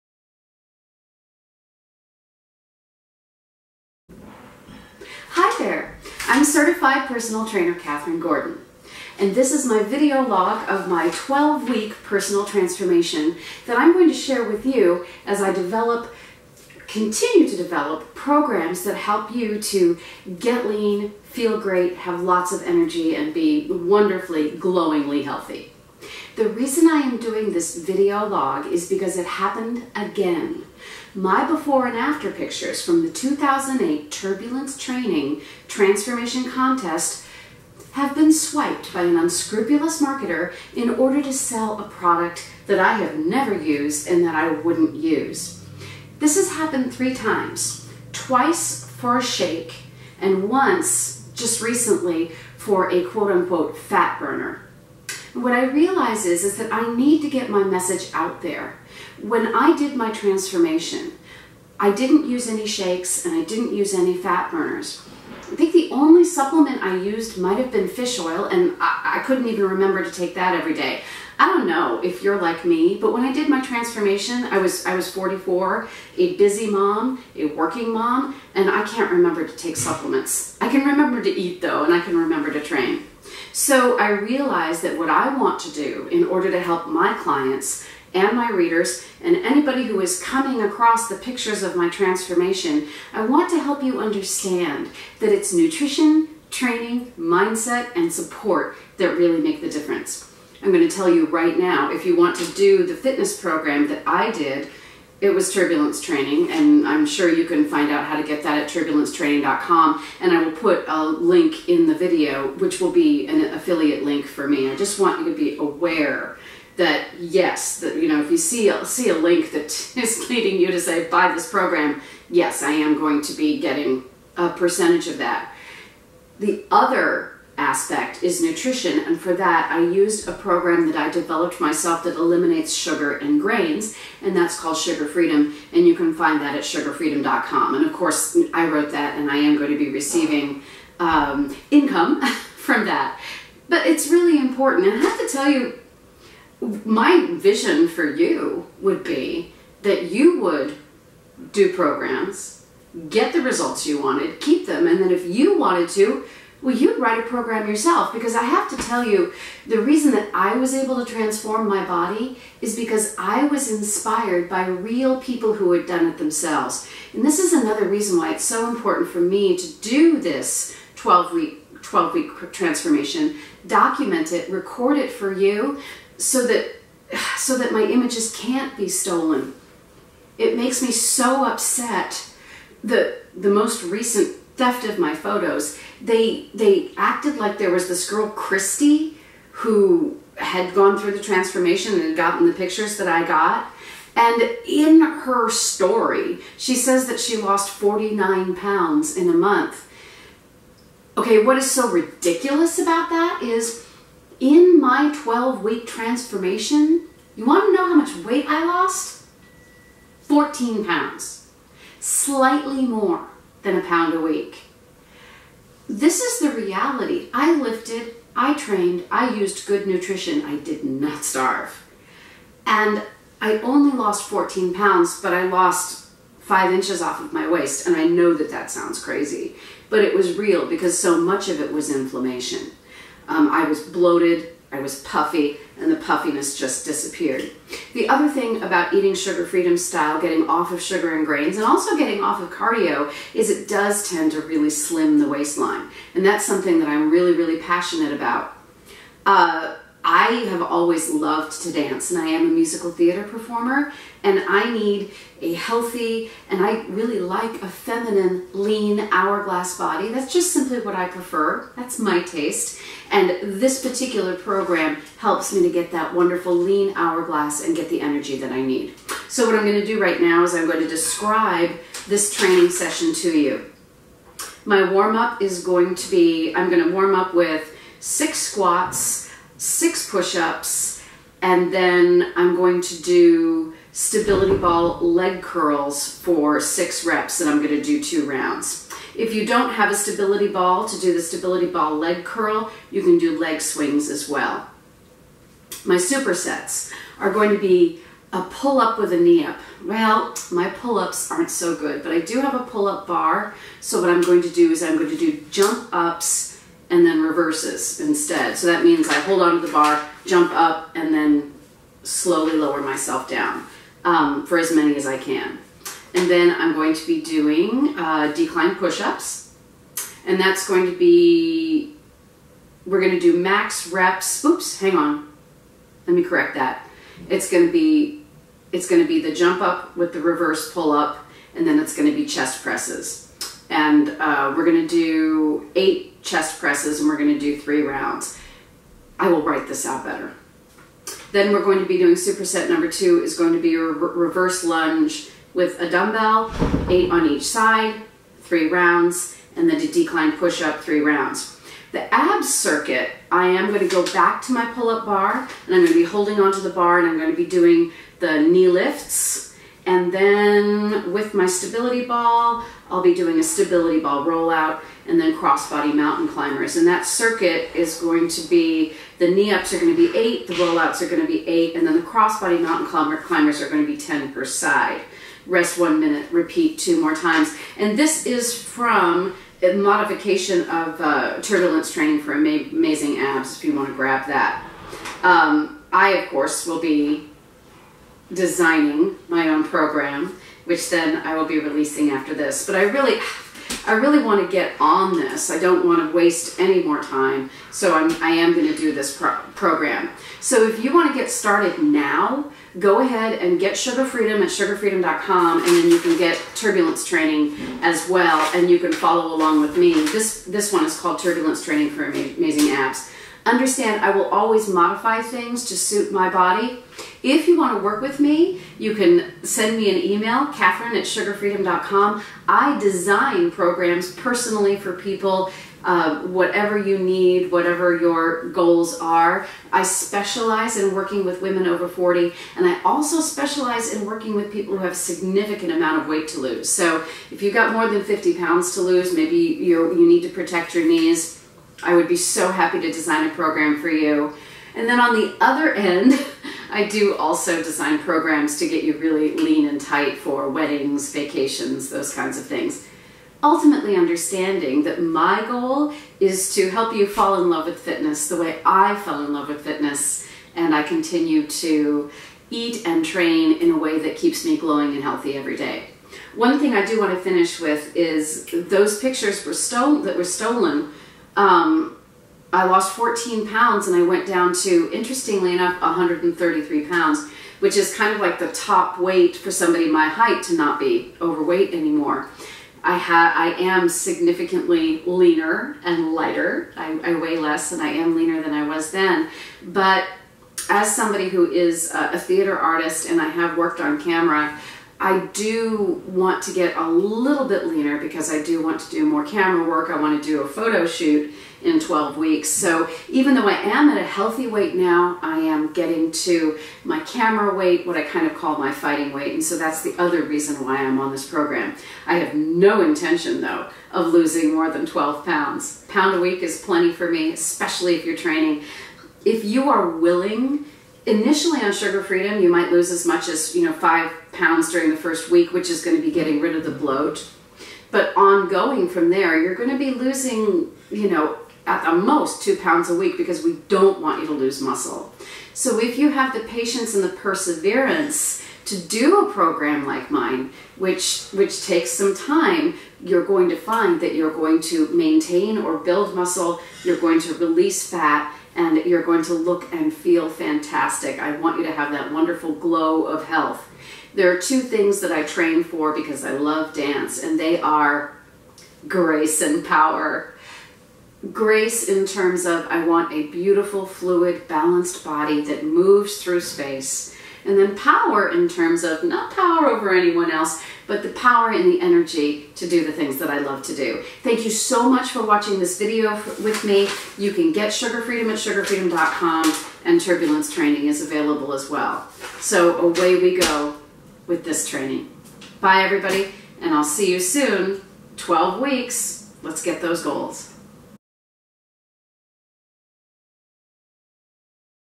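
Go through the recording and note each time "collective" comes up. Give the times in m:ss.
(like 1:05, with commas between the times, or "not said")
not said.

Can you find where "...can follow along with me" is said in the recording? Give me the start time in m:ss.
6:48.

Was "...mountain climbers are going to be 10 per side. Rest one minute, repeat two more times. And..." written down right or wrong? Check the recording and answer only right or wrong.
right.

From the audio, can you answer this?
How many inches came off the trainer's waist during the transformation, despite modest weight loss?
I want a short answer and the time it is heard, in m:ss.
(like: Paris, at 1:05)
5, at 3:46.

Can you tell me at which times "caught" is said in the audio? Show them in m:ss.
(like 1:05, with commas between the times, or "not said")
not said.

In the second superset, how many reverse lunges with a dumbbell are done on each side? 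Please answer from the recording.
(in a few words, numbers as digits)
8.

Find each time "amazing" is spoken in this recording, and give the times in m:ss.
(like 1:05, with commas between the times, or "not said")
6:22, 6:52.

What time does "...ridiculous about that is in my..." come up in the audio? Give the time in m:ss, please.
3:21.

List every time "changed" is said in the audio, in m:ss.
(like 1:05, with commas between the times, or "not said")
not said.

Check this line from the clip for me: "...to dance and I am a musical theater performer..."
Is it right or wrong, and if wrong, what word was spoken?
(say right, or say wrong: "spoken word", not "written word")
right.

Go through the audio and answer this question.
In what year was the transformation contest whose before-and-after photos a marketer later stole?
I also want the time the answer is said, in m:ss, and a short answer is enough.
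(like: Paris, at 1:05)
2008, at 0:33.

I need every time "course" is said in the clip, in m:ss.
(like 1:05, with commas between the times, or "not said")
2:17, 6:26.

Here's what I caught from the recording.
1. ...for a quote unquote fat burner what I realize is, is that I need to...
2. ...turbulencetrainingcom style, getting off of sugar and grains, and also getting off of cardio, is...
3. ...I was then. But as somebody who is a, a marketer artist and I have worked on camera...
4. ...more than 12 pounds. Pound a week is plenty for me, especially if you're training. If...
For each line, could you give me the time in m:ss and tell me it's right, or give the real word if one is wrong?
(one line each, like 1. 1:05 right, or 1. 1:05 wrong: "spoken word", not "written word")
1. 0:52 right
2. 3:59 wrong: "freedom", not "turbulencetrainingcom"
3. 8:08 wrong: "theater", not "marketer"
4. 8:34 right.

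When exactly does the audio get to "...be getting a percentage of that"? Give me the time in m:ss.
2:03.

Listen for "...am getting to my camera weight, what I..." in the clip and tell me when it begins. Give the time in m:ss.
8:25.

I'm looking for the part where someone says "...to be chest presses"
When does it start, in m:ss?
5:32.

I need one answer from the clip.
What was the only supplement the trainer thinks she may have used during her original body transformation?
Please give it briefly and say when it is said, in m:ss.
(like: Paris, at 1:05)
fish oil, at 1:07.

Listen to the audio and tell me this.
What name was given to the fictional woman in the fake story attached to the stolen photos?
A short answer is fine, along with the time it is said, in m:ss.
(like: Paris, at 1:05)
Christy, at 3:08.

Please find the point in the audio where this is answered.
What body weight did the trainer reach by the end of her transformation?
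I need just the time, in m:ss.
7:55.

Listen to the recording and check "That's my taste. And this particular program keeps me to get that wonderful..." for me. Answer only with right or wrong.
wrong.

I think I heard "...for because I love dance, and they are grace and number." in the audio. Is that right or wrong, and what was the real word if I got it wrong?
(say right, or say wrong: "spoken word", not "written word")
wrong: "power", not "number".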